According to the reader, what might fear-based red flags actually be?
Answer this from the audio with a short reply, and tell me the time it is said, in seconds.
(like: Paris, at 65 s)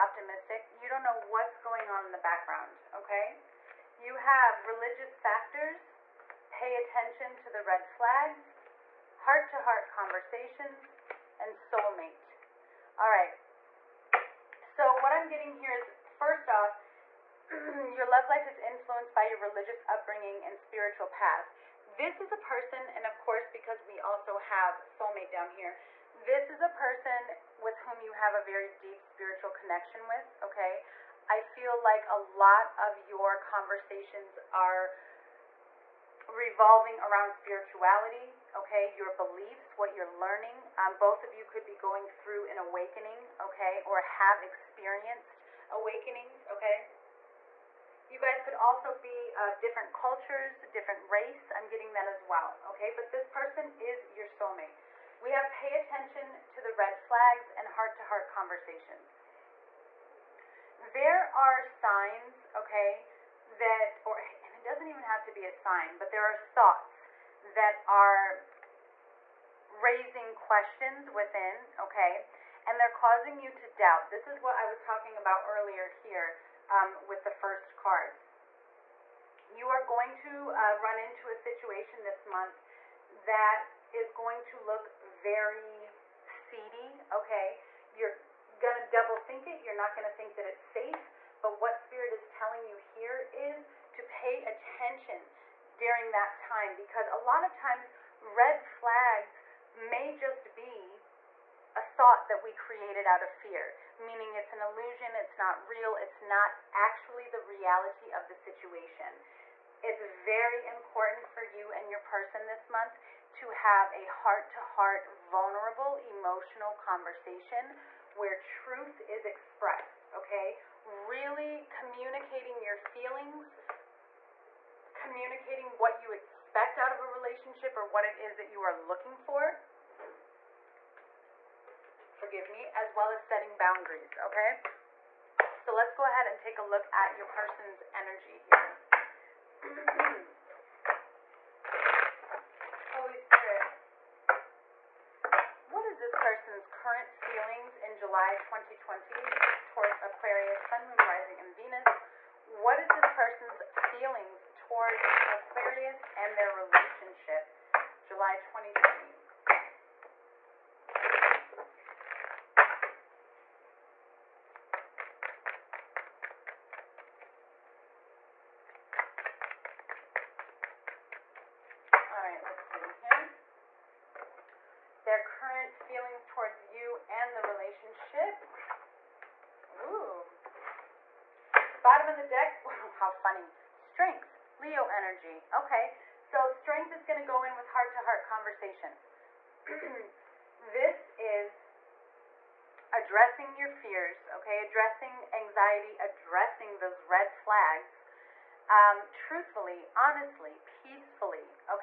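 An illusion, at 104 s.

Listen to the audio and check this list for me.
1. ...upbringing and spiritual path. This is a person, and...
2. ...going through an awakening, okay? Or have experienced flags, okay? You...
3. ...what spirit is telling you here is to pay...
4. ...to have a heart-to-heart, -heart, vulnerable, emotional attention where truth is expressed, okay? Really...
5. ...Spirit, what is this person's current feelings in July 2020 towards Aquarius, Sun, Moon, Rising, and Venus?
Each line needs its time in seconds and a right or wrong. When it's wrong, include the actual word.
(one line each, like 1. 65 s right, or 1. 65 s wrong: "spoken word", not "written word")
1. 19 s right
2. 41 s wrong: "awakenings", not "flags"
3. 91 s right
4. 113 s wrong: "conversation", not "attention"
5. 143 s right.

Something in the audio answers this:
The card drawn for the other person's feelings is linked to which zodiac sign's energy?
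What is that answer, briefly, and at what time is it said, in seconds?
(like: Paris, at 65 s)
Leo, at 184 s.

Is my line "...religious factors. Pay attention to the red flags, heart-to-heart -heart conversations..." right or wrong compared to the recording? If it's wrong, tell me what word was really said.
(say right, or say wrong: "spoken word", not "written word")
right.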